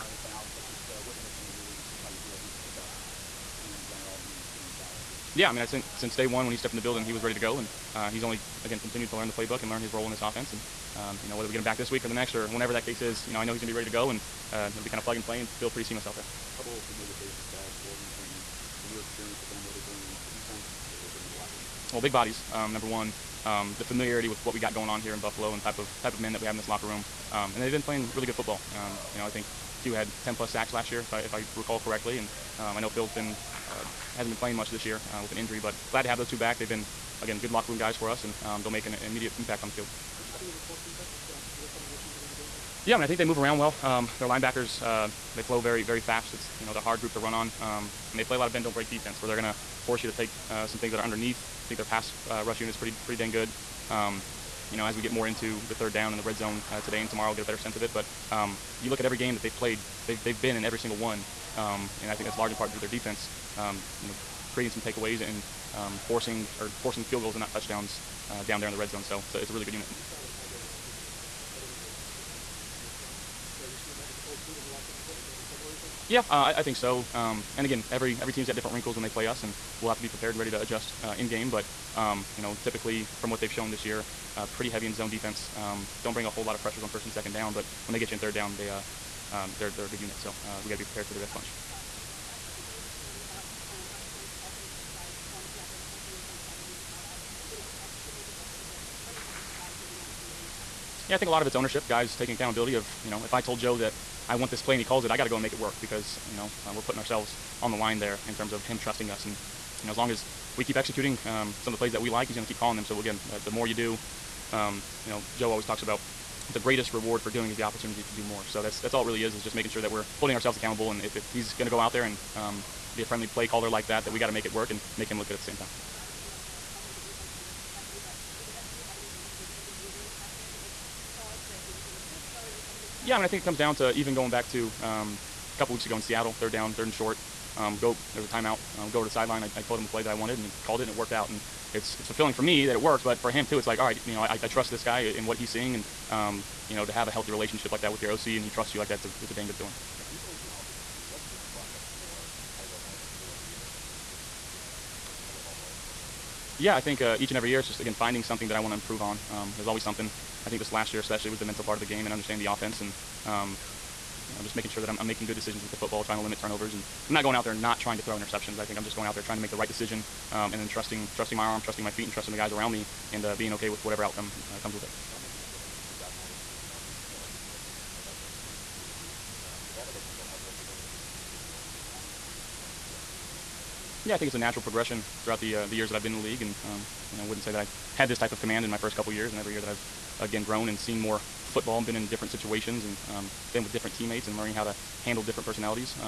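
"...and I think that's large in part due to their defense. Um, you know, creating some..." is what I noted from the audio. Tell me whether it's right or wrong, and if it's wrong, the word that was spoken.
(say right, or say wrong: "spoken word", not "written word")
right.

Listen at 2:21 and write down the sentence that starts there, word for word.
And it's it's fulfilling for me that it worked, but for him too.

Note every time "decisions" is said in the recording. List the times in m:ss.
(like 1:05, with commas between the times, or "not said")
2:45, 2:49.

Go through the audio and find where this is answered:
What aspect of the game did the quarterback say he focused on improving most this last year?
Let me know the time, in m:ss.
2:41.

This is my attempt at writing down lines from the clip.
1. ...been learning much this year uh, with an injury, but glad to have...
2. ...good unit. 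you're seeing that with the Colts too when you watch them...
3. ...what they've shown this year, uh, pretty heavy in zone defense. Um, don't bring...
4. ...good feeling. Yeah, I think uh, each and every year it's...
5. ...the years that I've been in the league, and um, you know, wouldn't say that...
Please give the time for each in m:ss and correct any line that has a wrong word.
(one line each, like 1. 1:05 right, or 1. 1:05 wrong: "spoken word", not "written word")
1. 0:34 wrong: "playing", not "learning"
2. 1:09 right
3. 1:23 right
4. 2:29 right
5. 3:05 right.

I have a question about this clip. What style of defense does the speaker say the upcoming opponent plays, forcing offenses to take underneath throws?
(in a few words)
Bend, don't break.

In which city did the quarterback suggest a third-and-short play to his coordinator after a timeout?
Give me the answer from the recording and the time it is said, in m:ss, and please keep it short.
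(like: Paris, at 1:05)
Seattle, at 2:16.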